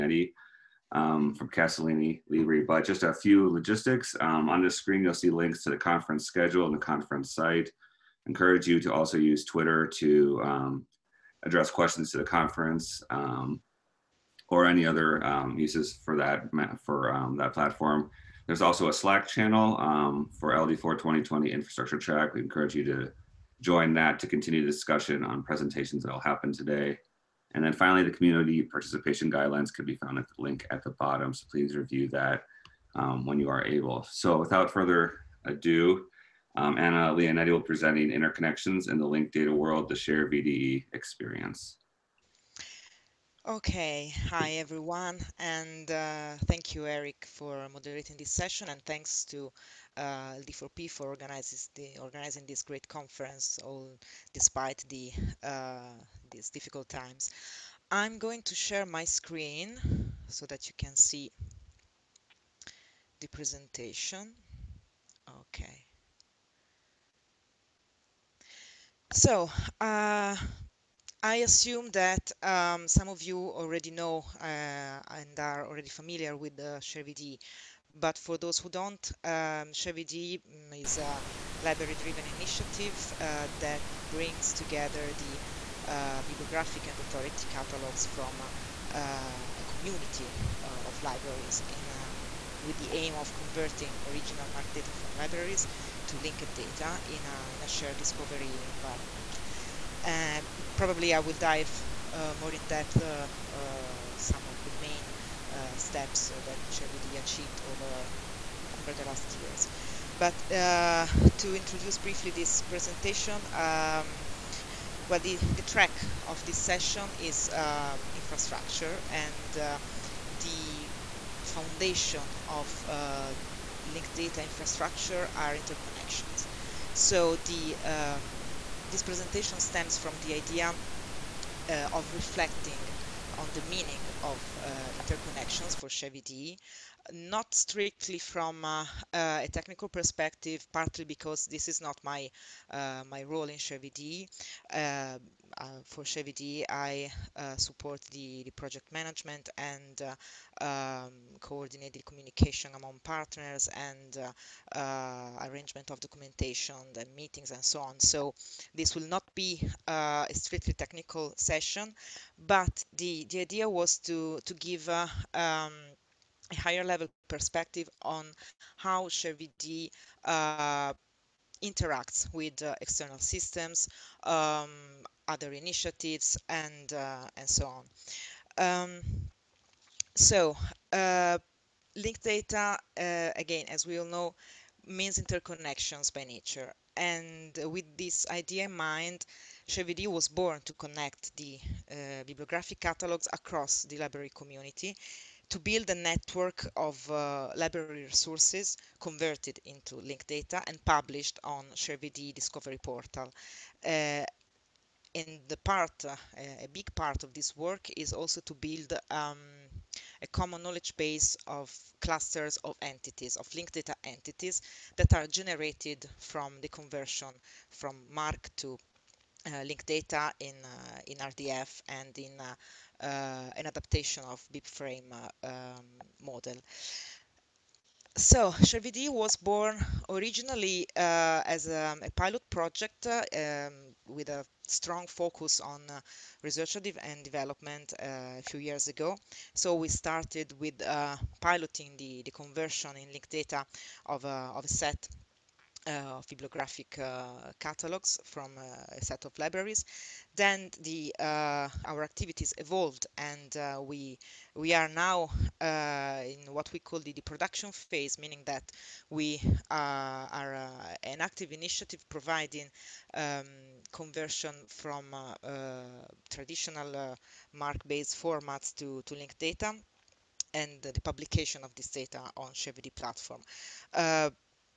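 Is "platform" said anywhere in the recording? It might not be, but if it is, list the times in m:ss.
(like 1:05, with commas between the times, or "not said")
0:17, 4:32.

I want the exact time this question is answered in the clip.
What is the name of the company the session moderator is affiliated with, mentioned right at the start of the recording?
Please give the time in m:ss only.
0:01.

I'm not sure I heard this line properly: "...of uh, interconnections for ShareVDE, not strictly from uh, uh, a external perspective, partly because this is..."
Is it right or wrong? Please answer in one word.
wrong.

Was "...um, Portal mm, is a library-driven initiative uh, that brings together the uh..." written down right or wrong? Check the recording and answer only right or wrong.
wrong.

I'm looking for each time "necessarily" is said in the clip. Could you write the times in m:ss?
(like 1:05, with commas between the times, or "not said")
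not said.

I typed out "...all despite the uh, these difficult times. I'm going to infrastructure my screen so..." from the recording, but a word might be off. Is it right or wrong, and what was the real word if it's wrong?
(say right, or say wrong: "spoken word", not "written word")
wrong: "share", not "infrastructure".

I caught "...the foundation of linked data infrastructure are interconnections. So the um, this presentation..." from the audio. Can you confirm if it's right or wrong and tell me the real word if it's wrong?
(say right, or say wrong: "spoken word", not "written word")
right.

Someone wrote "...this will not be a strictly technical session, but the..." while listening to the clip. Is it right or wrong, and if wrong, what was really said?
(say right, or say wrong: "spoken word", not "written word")
right.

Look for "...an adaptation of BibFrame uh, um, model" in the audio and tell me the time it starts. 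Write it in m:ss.
3:43.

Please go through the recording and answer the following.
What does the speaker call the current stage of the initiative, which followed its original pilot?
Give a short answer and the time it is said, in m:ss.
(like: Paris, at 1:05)
production phase, at 4:17.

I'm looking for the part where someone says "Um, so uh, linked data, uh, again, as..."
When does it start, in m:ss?
2:58.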